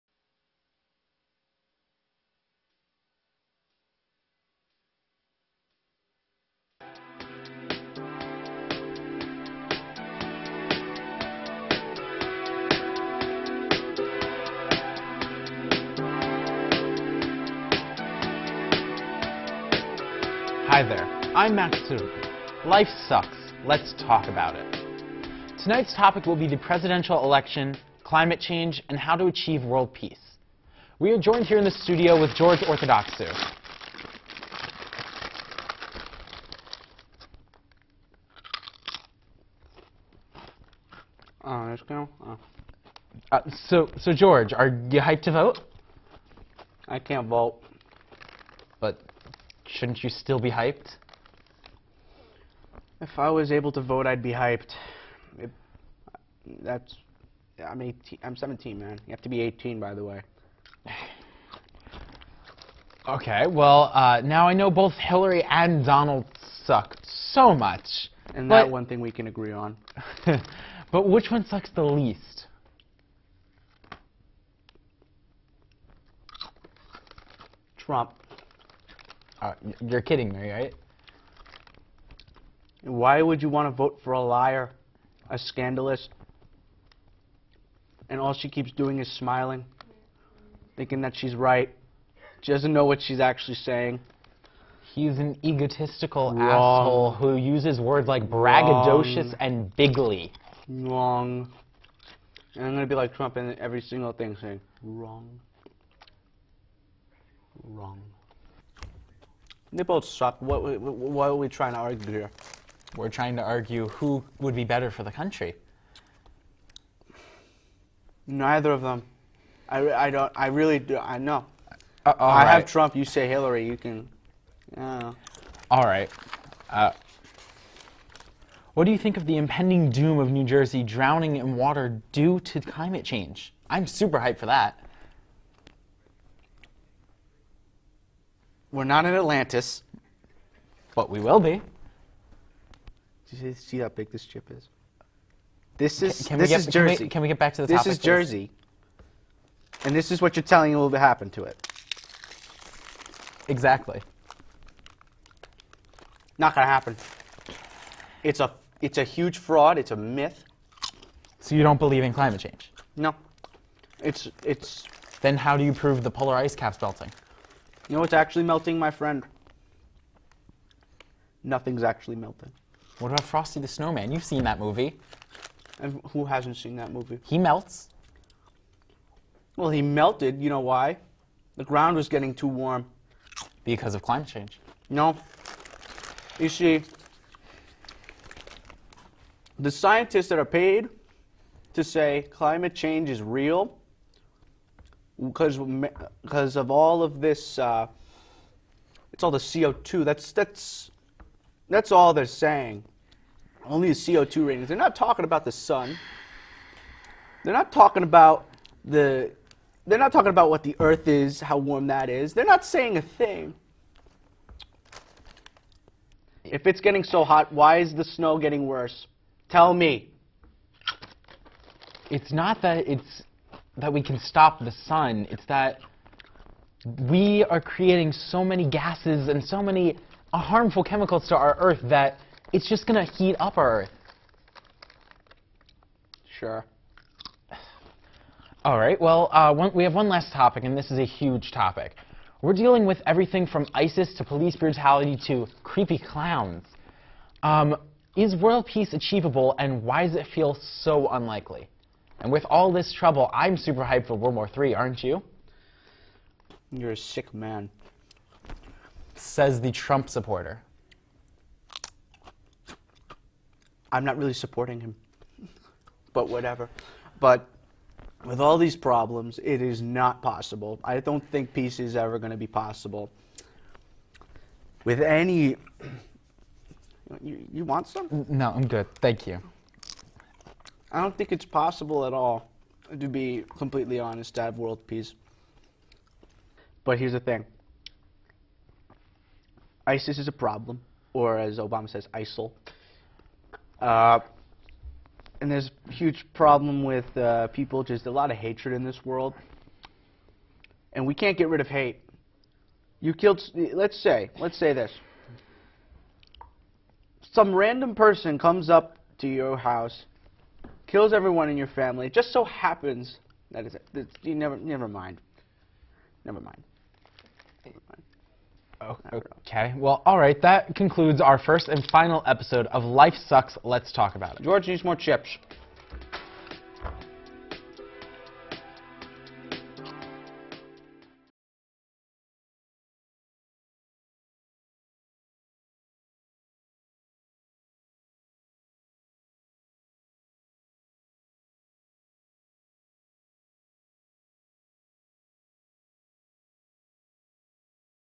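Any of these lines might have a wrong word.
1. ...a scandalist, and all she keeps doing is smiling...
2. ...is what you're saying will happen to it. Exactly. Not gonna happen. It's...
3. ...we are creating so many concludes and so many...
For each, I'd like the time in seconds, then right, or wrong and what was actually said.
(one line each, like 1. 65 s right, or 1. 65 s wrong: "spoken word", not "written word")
1. 85 s right
2. 150 s wrong: "telling", not "saying"
3. 227 s wrong: "gases", not "concludes".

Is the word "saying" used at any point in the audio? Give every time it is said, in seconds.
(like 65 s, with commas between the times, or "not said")
93 s, 104 s, 202 s, 212 s.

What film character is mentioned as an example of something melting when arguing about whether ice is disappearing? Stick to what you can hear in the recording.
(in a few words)
Frosty the Snowman.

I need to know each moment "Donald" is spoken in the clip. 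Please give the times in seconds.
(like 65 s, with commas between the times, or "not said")
65 s.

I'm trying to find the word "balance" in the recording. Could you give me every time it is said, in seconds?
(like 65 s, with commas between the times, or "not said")
not said.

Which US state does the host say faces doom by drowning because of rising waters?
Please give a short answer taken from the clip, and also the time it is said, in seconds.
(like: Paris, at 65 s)
New Jersey, at 130 s.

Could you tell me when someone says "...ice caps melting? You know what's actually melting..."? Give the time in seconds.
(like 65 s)
166 s.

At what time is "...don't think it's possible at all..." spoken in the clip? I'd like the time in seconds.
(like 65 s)
281 s.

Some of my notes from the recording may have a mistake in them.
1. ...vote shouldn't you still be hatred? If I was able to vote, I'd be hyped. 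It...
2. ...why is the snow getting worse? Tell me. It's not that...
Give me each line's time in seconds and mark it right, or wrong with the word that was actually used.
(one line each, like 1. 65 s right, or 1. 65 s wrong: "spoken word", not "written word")
1. 47 s wrong: "hyped", not "hatred"
2. 217 s right.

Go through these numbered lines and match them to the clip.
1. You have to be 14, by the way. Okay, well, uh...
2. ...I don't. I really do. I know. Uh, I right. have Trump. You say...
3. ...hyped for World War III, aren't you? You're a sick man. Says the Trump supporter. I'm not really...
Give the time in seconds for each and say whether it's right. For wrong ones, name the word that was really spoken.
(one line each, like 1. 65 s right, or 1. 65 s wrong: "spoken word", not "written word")
1. 59 s wrong: "18", not "14"
2. 119 s right
3. 253 s right.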